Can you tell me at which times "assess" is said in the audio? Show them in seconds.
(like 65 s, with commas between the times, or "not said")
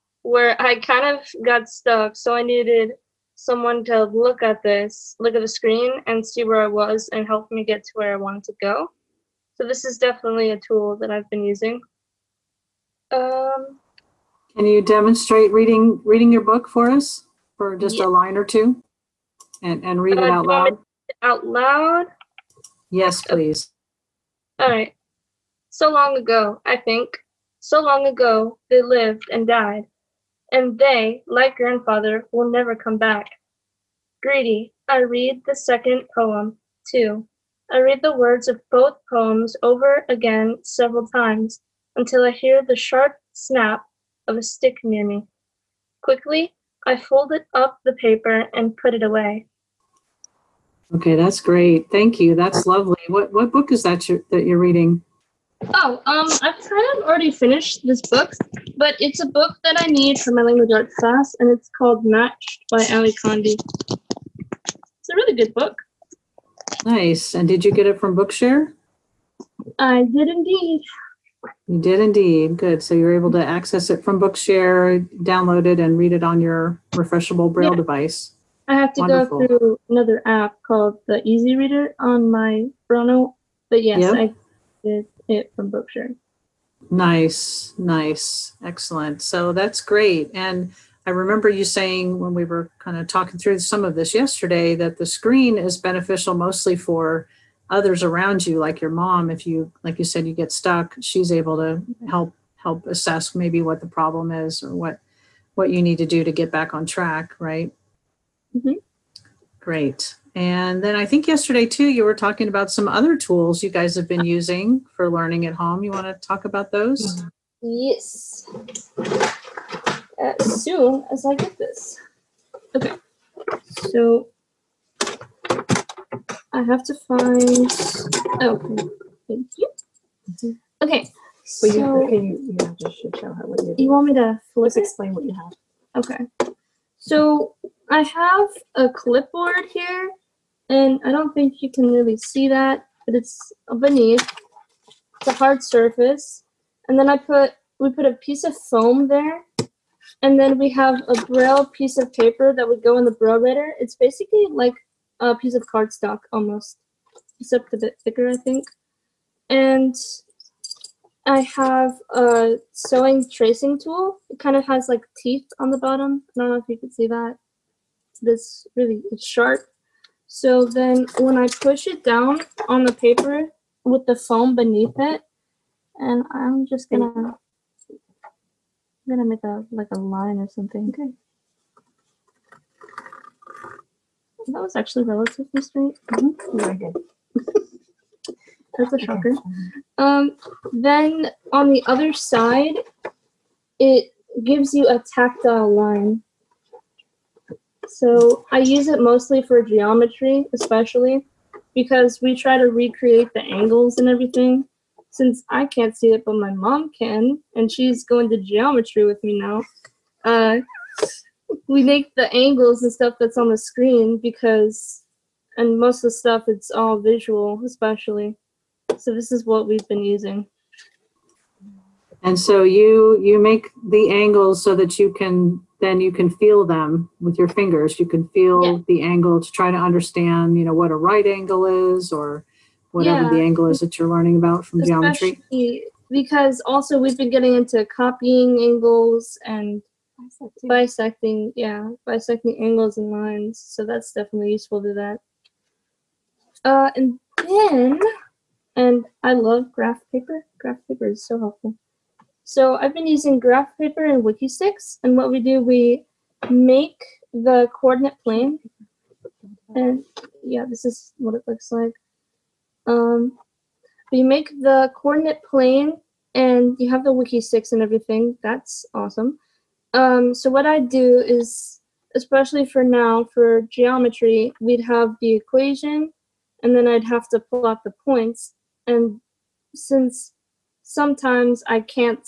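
102 s.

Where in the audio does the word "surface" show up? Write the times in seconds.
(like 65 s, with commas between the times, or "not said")
145 s.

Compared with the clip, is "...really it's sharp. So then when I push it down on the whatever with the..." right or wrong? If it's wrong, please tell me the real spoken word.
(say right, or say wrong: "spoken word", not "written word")
wrong: "paper", not "whatever".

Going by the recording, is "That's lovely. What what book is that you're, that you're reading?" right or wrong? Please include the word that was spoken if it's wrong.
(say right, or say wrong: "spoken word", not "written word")
right.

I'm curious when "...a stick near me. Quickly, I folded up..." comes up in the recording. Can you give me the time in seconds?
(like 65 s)
44 s.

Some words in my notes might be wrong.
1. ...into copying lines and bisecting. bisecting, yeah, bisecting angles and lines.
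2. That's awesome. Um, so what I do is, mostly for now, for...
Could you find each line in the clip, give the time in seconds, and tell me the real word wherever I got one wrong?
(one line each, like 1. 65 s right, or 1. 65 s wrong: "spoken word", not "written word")
1. 237 s wrong: "angles", not "lines"
2. 268 s wrong: "especially", not "mostly".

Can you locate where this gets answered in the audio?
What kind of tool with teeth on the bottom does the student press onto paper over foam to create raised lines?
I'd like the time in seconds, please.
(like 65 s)
162 s.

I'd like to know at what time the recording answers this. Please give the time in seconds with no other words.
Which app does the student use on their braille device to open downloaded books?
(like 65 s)
81 s.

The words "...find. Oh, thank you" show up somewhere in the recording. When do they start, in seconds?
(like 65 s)
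127 s.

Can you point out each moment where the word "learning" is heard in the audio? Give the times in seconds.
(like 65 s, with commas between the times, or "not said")
115 s, 234 s.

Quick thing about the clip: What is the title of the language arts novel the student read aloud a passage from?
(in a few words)
Matched.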